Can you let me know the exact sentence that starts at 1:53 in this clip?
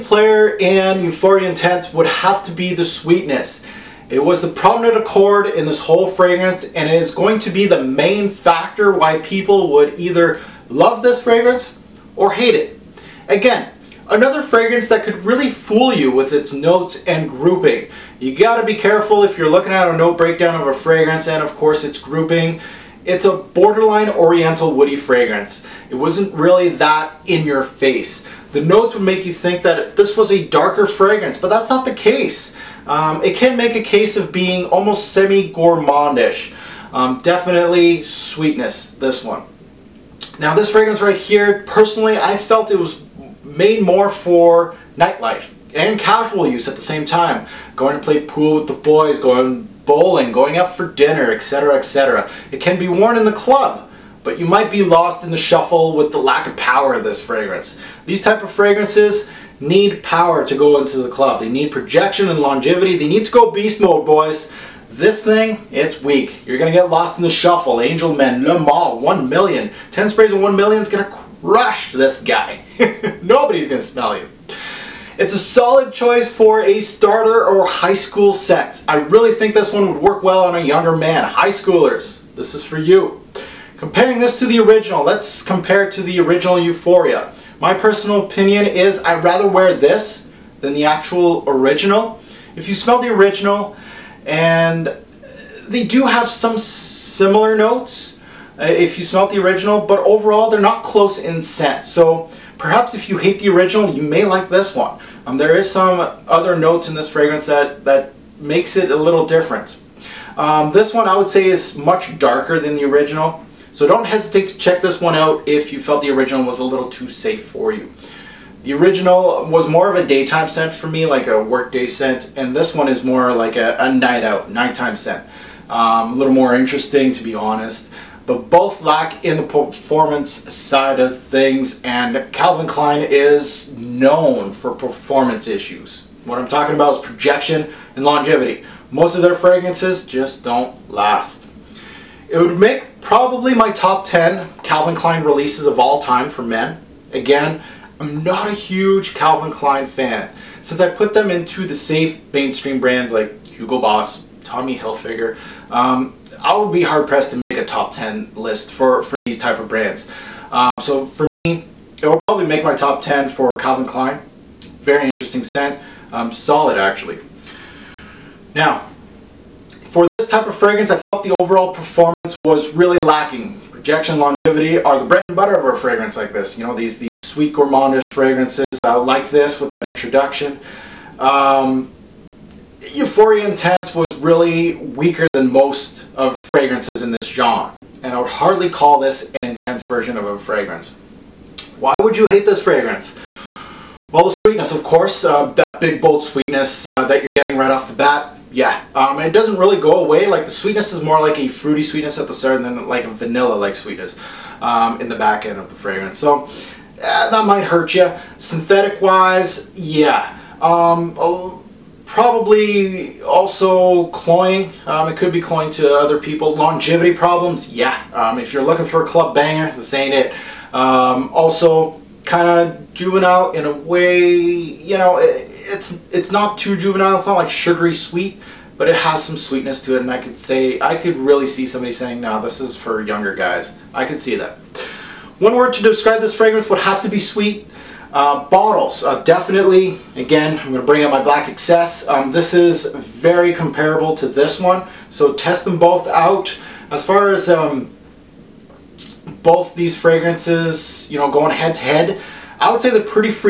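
So don't hesitate to check this one out if you felt the original was a little too safe for you.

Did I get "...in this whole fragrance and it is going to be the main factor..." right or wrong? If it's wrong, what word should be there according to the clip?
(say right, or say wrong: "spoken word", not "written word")
right.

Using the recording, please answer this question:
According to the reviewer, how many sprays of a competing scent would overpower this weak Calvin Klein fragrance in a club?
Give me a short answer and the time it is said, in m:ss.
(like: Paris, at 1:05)
10, at 1:09.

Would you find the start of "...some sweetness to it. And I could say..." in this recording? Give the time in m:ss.
3:49.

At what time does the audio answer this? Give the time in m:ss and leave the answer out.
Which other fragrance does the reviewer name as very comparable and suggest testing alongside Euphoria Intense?
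4:01.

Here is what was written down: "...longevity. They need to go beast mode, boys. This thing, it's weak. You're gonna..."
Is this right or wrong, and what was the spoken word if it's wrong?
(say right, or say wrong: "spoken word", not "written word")
right.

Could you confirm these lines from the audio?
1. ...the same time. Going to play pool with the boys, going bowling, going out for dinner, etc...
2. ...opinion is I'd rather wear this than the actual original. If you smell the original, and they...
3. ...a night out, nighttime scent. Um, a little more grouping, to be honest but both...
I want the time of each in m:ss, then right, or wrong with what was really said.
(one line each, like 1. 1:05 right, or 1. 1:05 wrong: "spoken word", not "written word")
1. 0:46 right
2. 1:28 right
3. 2:03 wrong: "interesting", not "grouping".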